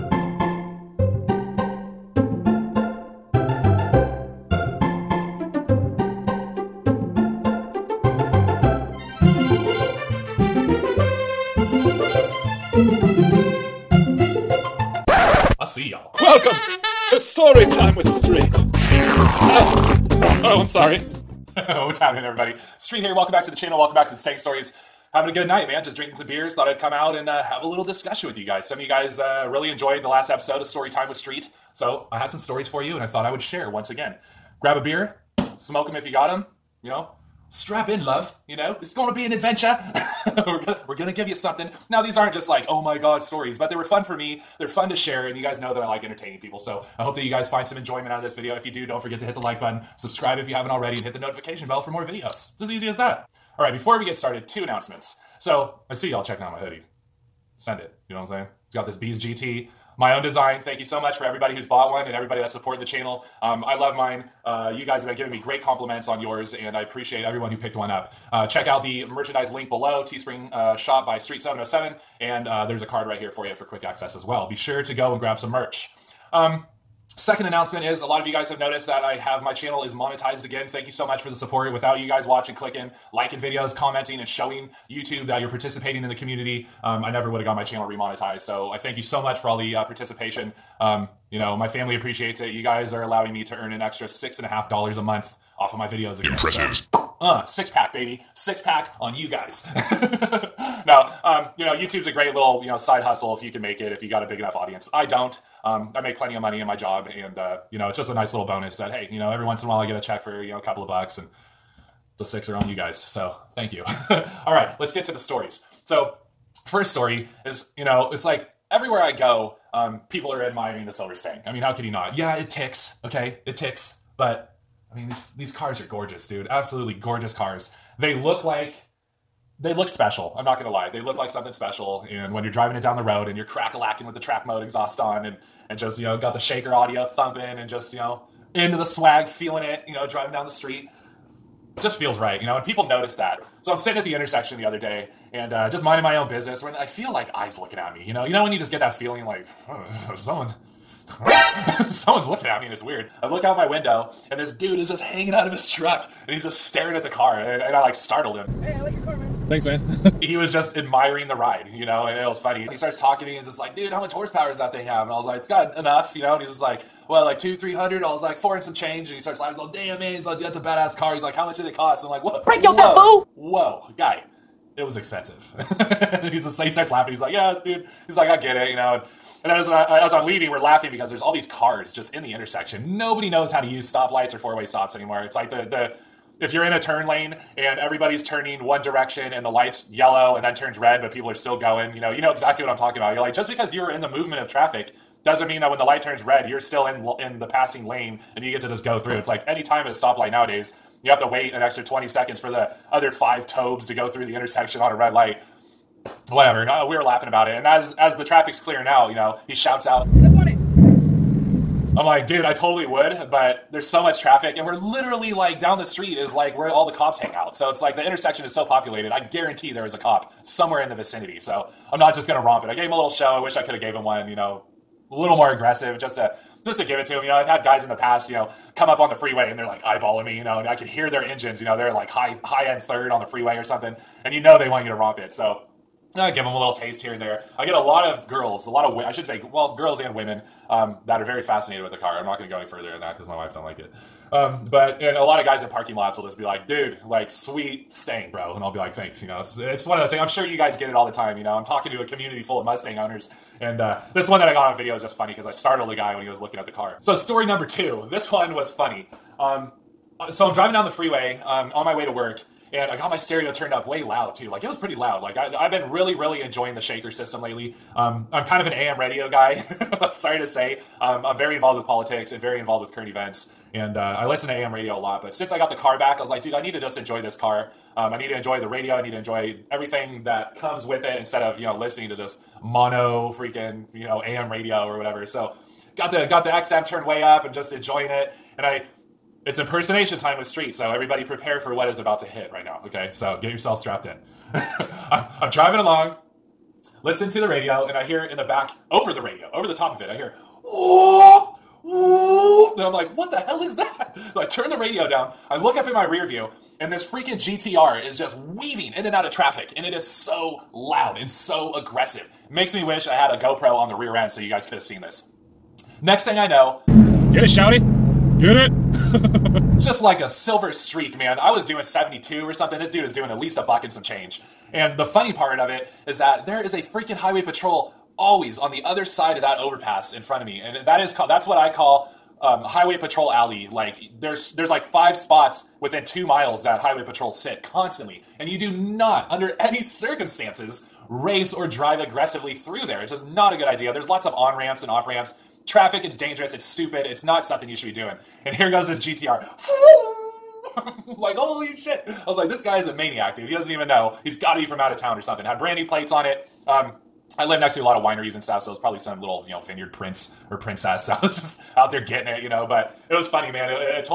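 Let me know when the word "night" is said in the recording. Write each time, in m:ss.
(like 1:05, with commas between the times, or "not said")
0:25.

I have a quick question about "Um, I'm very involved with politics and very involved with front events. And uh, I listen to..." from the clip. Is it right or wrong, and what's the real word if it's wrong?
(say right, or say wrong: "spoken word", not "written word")
wrong: "current", not "front".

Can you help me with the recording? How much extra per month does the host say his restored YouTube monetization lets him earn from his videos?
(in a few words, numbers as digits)
$6.50.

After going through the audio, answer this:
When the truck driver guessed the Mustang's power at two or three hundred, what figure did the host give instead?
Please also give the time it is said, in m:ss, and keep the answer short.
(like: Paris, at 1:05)
400 and some change, at 2:48.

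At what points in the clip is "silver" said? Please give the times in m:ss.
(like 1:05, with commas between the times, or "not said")
2:00, 5:20.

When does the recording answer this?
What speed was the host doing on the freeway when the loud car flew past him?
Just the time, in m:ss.
5:21.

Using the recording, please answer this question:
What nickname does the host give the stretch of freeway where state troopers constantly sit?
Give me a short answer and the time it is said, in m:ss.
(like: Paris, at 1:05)
highway patrol alley, at 5:32.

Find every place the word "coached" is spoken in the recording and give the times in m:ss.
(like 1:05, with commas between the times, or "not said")
not said.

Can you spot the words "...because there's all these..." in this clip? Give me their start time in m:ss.
3:00.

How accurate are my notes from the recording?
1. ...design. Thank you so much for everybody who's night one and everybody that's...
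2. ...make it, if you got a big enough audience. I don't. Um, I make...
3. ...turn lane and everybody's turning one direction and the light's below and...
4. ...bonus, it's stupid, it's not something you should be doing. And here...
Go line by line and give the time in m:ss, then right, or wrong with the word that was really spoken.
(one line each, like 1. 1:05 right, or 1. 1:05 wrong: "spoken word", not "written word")
1. 1:00 wrong: "bought", not "night"
2. 1:43 right
3. 3:06 wrong: "yellow", not "below"
4. 5:46 wrong: "dangerous", not "bonus".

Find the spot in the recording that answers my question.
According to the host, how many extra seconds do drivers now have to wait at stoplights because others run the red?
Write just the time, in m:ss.
3:21.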